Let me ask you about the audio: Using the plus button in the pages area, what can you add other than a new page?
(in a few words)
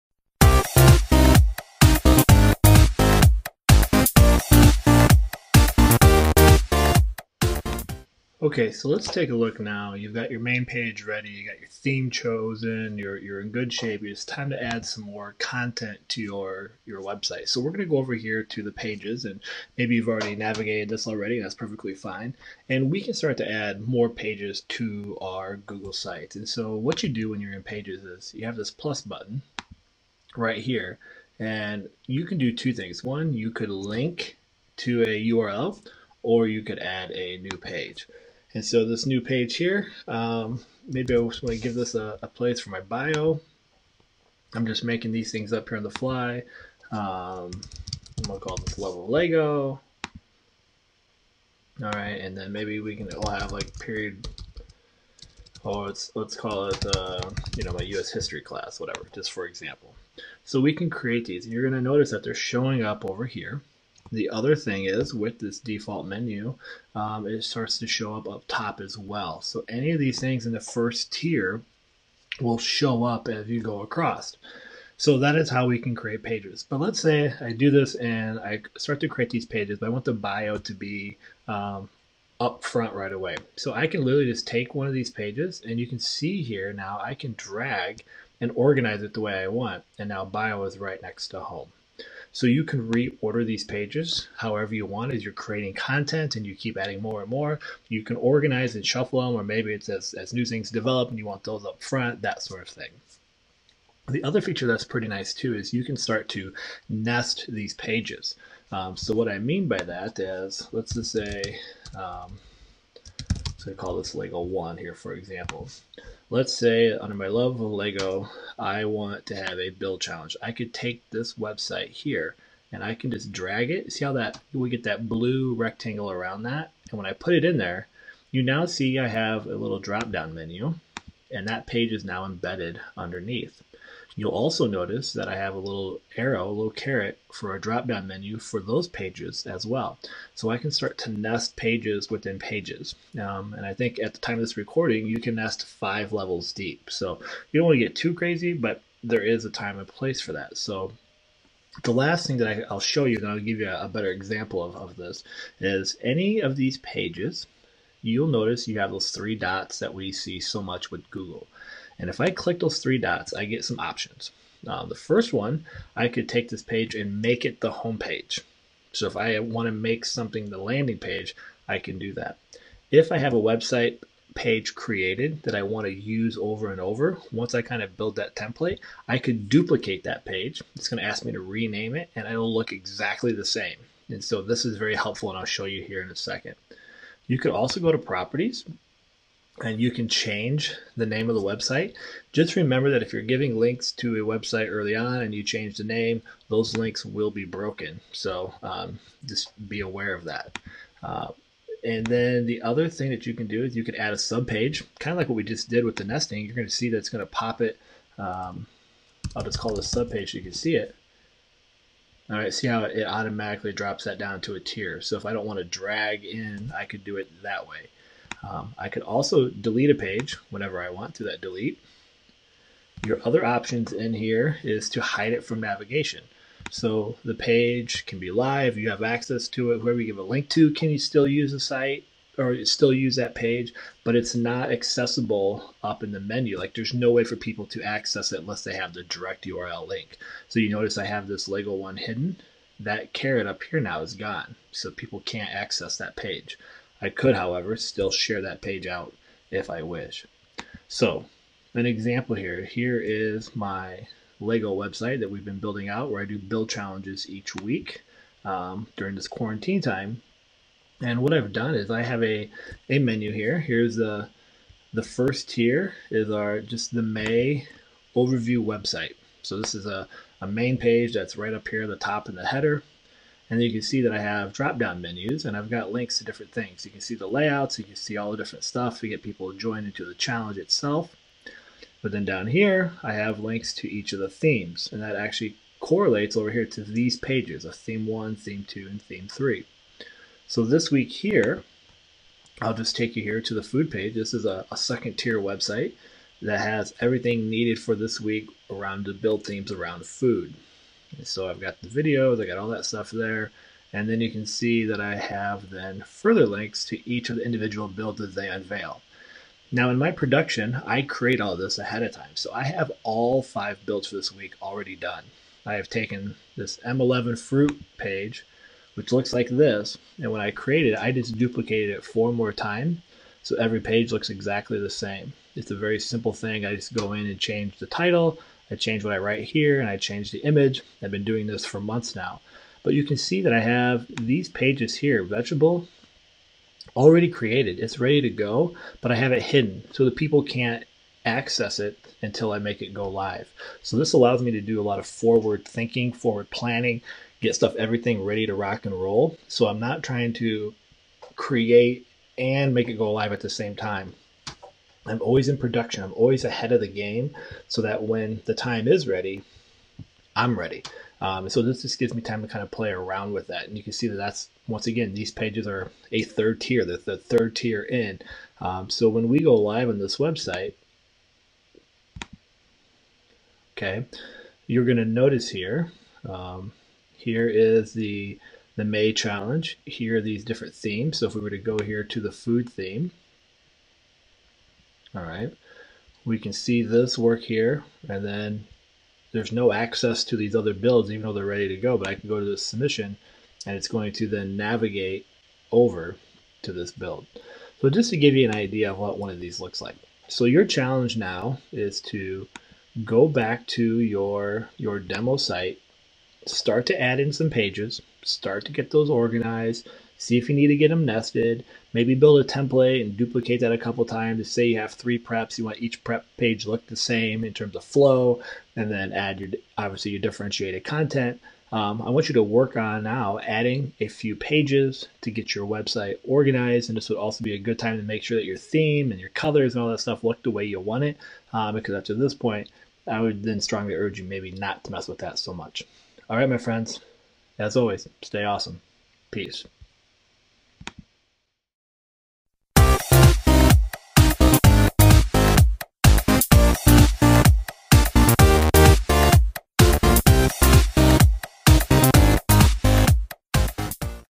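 Link to a URL.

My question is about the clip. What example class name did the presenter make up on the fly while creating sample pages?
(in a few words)
U.S. history class.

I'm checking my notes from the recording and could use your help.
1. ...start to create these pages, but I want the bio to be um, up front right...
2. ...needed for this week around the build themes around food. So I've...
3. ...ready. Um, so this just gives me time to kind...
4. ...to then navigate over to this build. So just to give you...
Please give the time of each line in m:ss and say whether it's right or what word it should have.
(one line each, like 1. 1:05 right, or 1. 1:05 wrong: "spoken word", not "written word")
1. 1:18 right
2. 4:57 right
3. 6:00 right
4. 6:34 right.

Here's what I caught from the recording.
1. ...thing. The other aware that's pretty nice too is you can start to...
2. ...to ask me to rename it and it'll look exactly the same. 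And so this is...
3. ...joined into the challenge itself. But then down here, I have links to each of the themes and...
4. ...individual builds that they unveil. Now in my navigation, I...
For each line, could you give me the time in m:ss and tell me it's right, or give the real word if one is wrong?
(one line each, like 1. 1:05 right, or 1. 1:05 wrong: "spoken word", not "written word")
1. 1:42 wrong: "feature", not "aware"
2. 3:01 right
3. 4:39 right
4. 5:07 wrong: "production", not "navigation".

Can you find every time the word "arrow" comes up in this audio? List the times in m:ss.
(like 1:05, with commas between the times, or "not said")
2:16.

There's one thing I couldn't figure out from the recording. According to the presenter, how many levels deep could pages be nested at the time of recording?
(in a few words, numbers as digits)
5.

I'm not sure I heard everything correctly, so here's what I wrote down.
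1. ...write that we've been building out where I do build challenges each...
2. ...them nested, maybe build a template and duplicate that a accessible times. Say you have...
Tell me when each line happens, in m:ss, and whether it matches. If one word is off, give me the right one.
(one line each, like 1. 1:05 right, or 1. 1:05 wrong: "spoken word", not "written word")
1. 4:14 wrong: "website", not "write"
2. 6:50 wrong: "couple", not "accessible".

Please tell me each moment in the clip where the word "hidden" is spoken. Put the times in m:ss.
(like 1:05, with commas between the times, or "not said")
4:01, 5:39.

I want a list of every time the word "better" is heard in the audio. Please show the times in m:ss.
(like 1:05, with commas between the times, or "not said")
2:33.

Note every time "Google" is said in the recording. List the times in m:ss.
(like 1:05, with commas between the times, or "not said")
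0:25, 2:41.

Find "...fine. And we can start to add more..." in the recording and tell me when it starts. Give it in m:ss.
0:21.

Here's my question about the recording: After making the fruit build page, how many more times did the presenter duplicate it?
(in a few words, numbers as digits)
4.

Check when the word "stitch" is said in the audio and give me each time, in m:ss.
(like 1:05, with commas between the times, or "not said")
not said.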